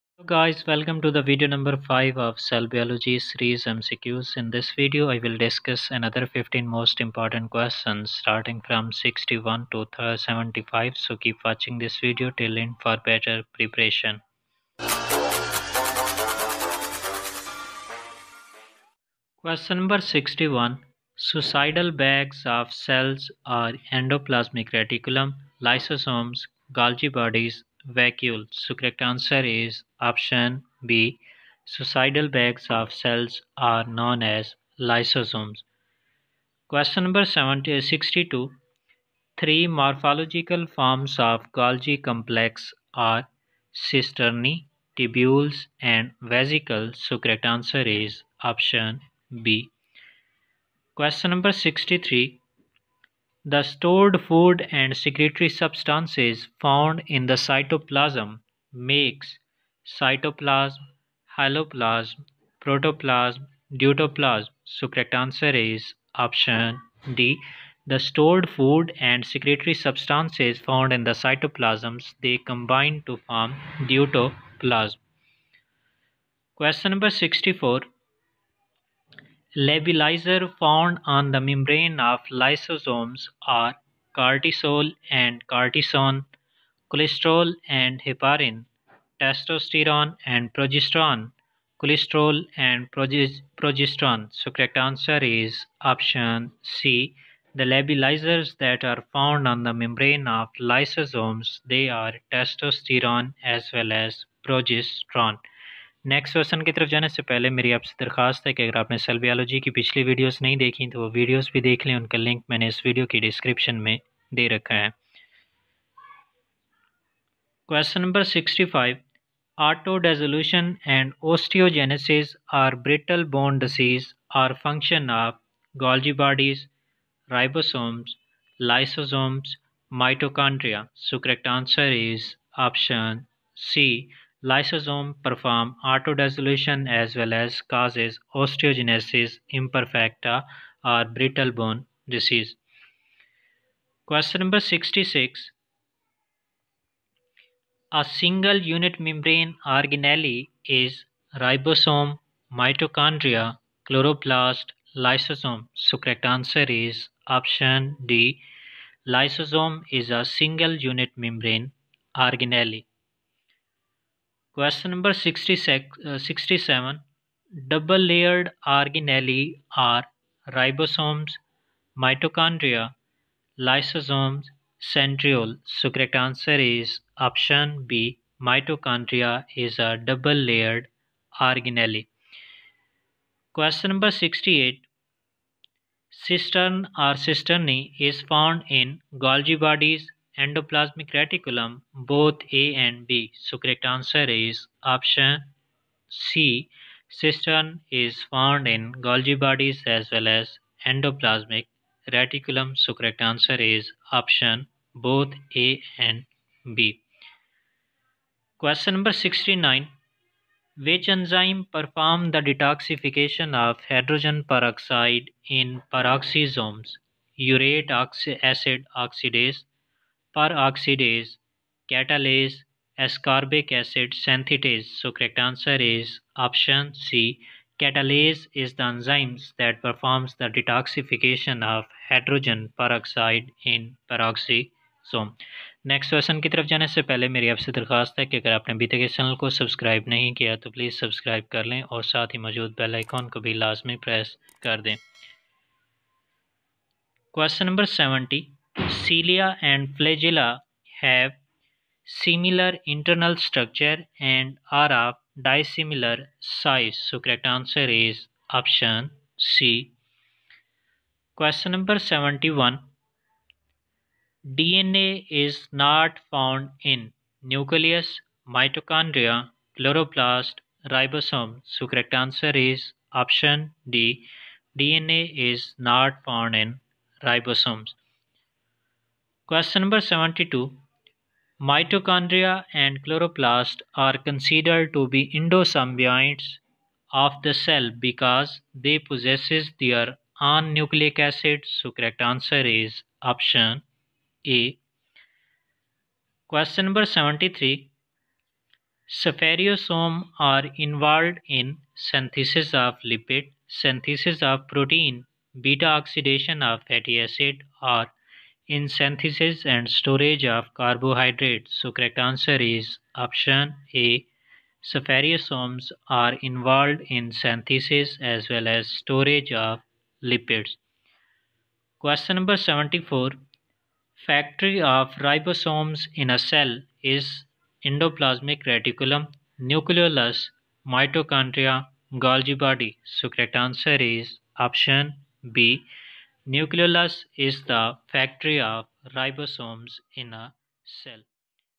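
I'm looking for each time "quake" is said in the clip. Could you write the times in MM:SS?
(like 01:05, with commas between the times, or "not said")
not said.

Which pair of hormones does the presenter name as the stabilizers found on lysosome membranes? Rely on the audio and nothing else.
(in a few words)
Testosterone and progesterone.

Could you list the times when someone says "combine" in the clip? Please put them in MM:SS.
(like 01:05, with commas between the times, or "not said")
01:12.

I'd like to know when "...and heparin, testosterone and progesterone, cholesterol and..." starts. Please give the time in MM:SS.
01:27.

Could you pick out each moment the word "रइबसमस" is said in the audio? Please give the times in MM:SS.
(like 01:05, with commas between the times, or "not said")
02:07, 02:50.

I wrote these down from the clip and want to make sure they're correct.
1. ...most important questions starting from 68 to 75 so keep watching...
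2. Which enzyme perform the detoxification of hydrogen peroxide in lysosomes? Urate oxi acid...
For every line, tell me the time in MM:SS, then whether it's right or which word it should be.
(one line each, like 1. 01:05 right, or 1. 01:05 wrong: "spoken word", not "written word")
1. 00:06 wrong: "61", not "68"
2. 03:30 wrong: "peroxisomes", not "lysosomes".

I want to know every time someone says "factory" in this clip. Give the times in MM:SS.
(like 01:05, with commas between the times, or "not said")
05:24, 05:38.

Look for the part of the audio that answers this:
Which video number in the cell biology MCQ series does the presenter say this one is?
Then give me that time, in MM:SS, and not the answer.
00:01.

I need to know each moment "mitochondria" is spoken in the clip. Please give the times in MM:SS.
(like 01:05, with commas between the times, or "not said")
02:32, 04:28, 04:41, 05:30.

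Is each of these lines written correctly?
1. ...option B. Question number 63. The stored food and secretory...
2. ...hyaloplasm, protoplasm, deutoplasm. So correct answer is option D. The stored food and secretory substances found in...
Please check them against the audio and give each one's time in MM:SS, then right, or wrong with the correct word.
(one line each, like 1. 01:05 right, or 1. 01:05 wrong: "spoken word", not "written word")
1. 00:48 right
2. 01:01 right.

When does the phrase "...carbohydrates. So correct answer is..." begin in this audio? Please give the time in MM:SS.
05:10.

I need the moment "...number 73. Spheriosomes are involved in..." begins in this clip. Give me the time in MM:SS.
04:56.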